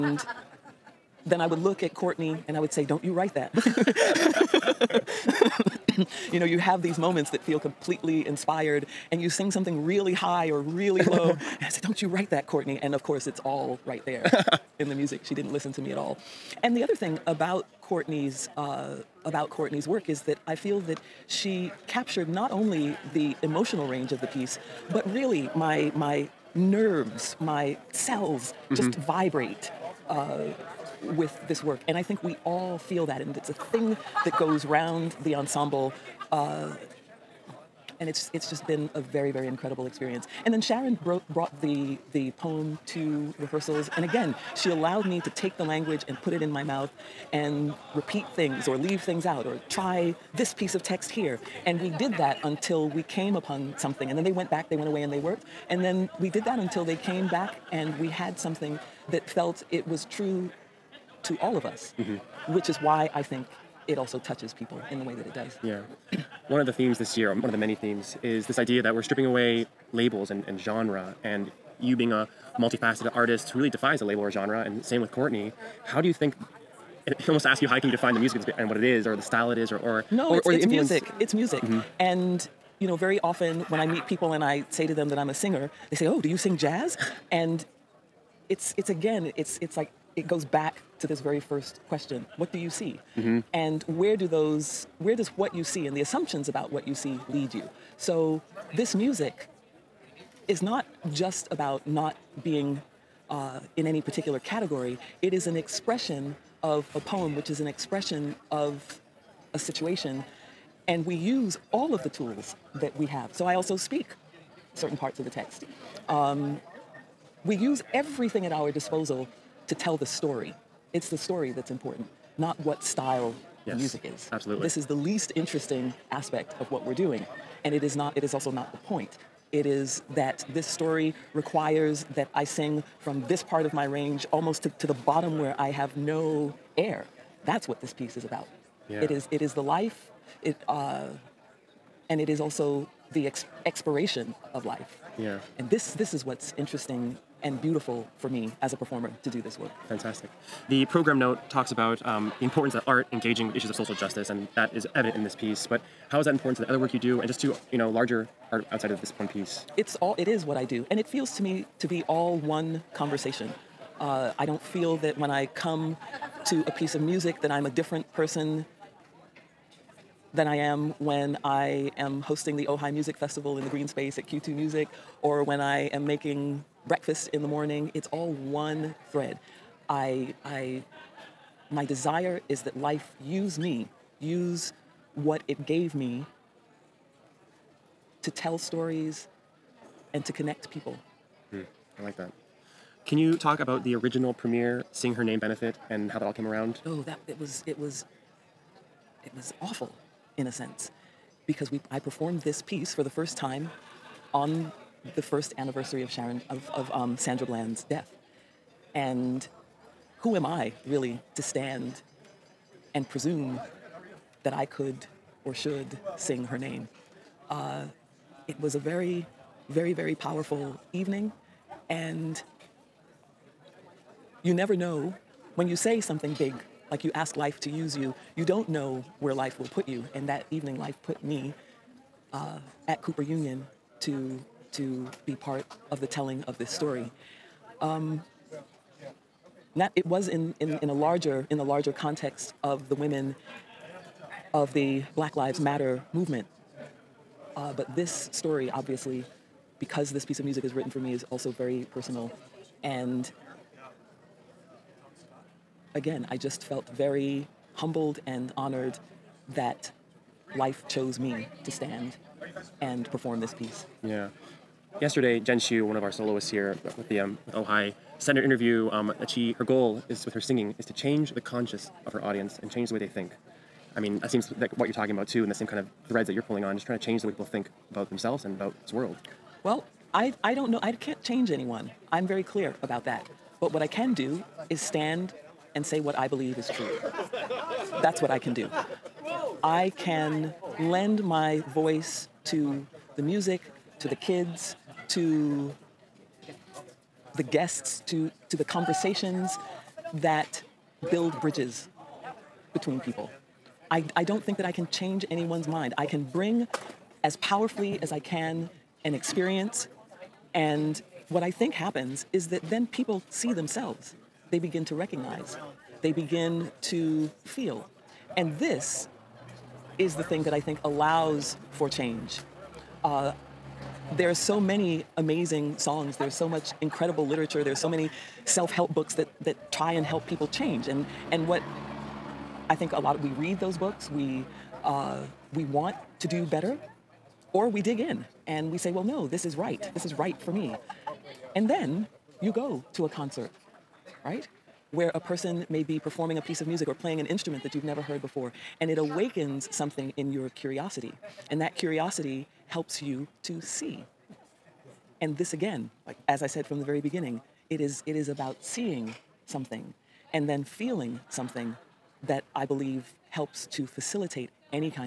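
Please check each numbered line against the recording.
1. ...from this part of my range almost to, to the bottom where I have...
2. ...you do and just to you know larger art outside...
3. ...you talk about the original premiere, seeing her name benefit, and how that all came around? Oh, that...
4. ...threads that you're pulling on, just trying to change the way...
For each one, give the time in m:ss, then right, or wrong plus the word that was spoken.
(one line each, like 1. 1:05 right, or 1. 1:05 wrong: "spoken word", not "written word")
1. 2:12 right
2. 2:36 right
3. 3:13 right
4. 4:36 right.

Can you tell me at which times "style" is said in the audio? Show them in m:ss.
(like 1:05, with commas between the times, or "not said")
1:19, 2:02.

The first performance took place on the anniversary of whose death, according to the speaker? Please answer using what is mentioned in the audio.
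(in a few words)
Sandra Bland.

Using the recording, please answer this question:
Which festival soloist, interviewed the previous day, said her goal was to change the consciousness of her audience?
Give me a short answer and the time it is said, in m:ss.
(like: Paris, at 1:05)
Jen Shyu, at 4:25.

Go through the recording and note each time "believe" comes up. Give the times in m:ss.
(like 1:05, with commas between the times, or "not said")
4:46, 6:02.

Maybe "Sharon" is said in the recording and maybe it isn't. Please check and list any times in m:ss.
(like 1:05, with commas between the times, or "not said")
0:40, 3:26.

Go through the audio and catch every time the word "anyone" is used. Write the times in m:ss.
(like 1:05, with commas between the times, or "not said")
4:41, 5:05.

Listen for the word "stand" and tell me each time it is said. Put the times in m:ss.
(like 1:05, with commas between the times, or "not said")
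3:31, 4:21, 4:44.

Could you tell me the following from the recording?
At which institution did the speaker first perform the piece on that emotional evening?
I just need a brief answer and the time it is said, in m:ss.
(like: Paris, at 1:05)
Cooper Union, at 3:52.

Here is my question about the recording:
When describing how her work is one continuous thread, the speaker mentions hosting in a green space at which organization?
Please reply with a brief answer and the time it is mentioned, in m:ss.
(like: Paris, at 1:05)
Q2 Music, at 2:54.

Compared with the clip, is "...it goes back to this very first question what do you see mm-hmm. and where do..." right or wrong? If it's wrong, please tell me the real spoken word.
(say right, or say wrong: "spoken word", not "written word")
right.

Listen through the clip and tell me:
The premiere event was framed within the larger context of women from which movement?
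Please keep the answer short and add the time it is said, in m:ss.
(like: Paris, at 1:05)
Black Lives Matter, at 4:05.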